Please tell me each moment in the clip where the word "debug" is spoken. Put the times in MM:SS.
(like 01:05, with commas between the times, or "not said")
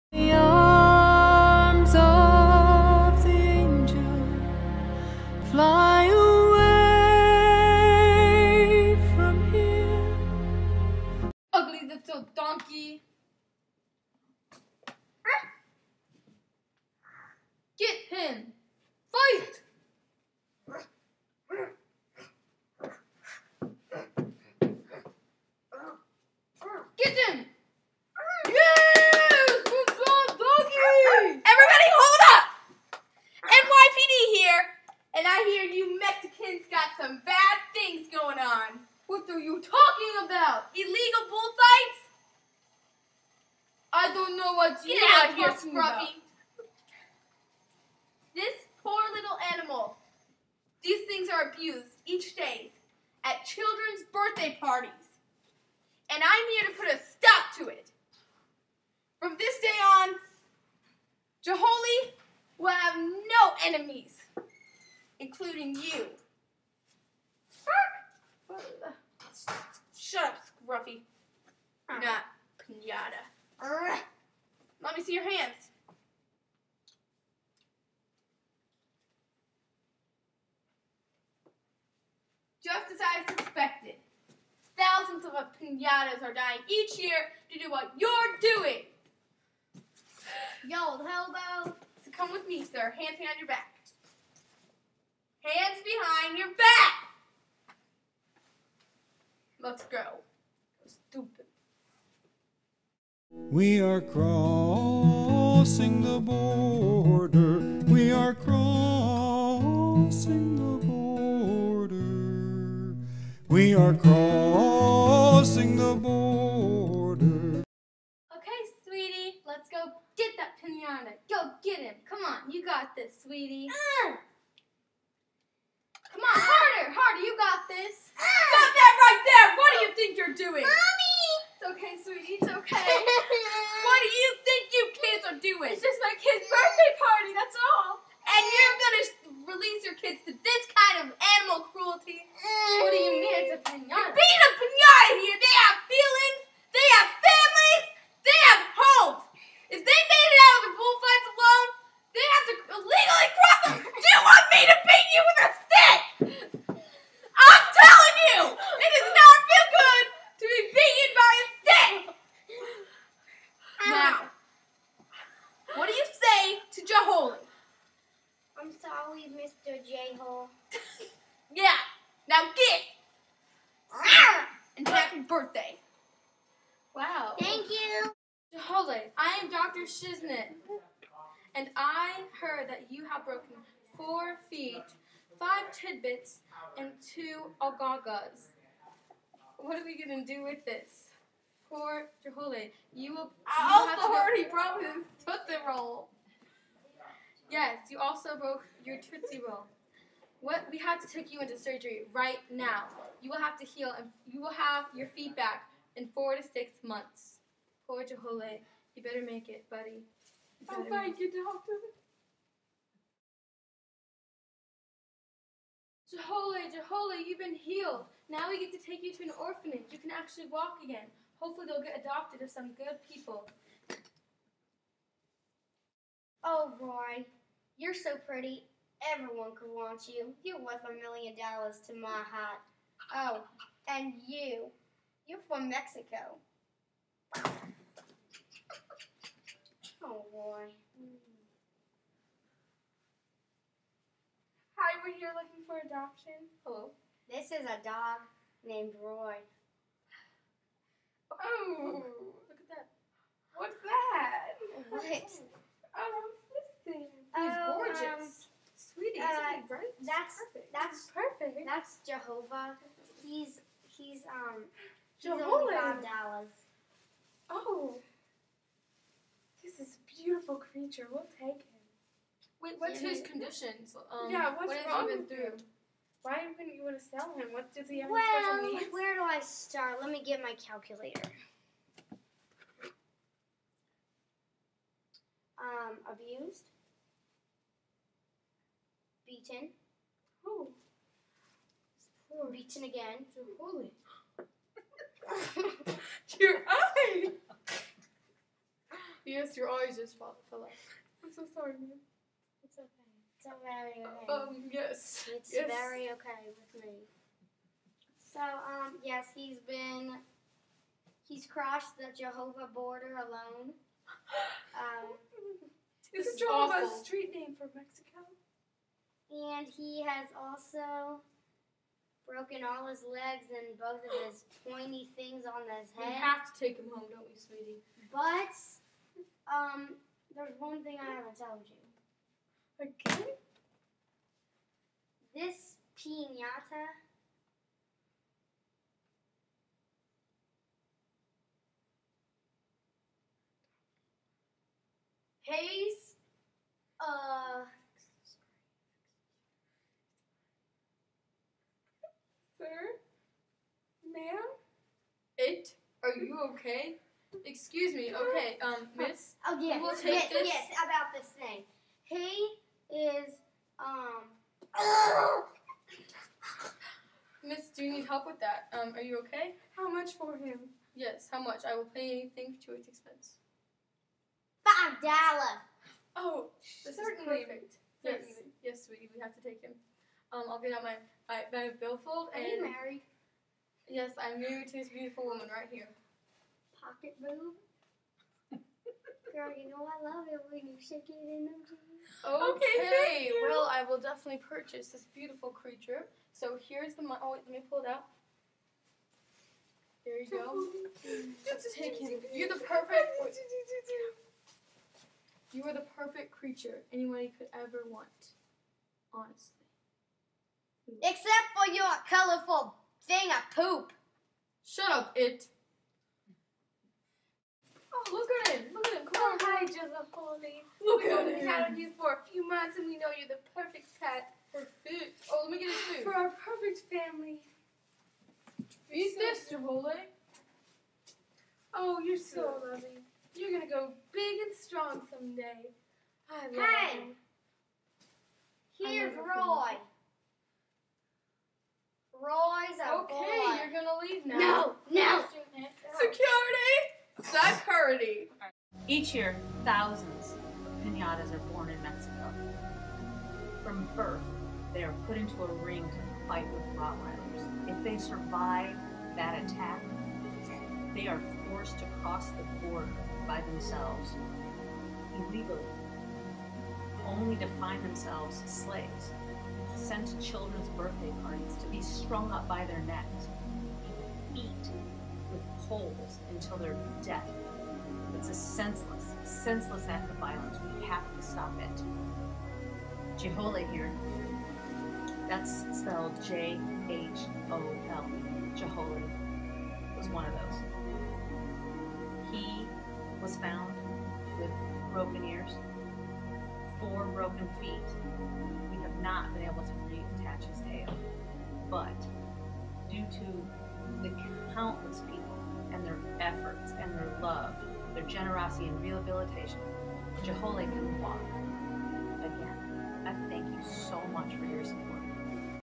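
not said.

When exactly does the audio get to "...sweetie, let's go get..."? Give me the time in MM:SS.
01:58.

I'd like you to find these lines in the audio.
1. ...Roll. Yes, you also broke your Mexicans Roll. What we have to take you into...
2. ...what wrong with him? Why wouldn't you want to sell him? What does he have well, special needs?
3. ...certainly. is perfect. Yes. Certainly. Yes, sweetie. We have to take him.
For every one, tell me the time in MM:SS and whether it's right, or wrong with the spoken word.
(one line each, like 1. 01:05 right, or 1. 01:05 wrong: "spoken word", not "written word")
1. 03:15 wrong: "Tootsie", not "Mexicans"
2. 04:34 right
3. 06:16 right.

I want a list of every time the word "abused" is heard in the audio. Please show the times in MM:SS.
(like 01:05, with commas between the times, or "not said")
00:51, 04:46.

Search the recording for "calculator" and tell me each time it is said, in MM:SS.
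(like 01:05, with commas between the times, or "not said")
04:40.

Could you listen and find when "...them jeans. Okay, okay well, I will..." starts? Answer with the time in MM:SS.
06:31.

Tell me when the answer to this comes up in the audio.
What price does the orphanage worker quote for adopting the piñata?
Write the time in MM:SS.
04:25.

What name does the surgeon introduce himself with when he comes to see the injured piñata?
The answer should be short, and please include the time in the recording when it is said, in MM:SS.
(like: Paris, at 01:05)
Dr. Shiznit, at 02:59.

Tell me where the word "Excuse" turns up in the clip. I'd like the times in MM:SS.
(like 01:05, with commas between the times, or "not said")
05:57.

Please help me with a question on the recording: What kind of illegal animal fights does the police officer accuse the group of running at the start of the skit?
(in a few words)
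Bullfights.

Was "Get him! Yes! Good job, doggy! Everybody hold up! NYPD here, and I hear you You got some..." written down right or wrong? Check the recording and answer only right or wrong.
wrong.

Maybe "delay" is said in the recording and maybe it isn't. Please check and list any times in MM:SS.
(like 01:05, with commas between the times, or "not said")
not said.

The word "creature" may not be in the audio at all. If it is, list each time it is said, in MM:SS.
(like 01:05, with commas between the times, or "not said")
04:30, 06:35, 06:46.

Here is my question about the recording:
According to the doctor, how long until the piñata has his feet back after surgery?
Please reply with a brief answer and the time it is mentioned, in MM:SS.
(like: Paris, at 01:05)
4 to 6 months, at 03:26.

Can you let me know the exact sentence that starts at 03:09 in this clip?
What are we going to do with this?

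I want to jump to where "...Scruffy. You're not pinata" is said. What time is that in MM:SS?
01:10.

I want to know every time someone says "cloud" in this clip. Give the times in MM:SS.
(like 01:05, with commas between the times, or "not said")
not said.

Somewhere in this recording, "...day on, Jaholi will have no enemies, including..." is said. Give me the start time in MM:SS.
00:59.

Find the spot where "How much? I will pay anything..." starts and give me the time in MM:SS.
06:11.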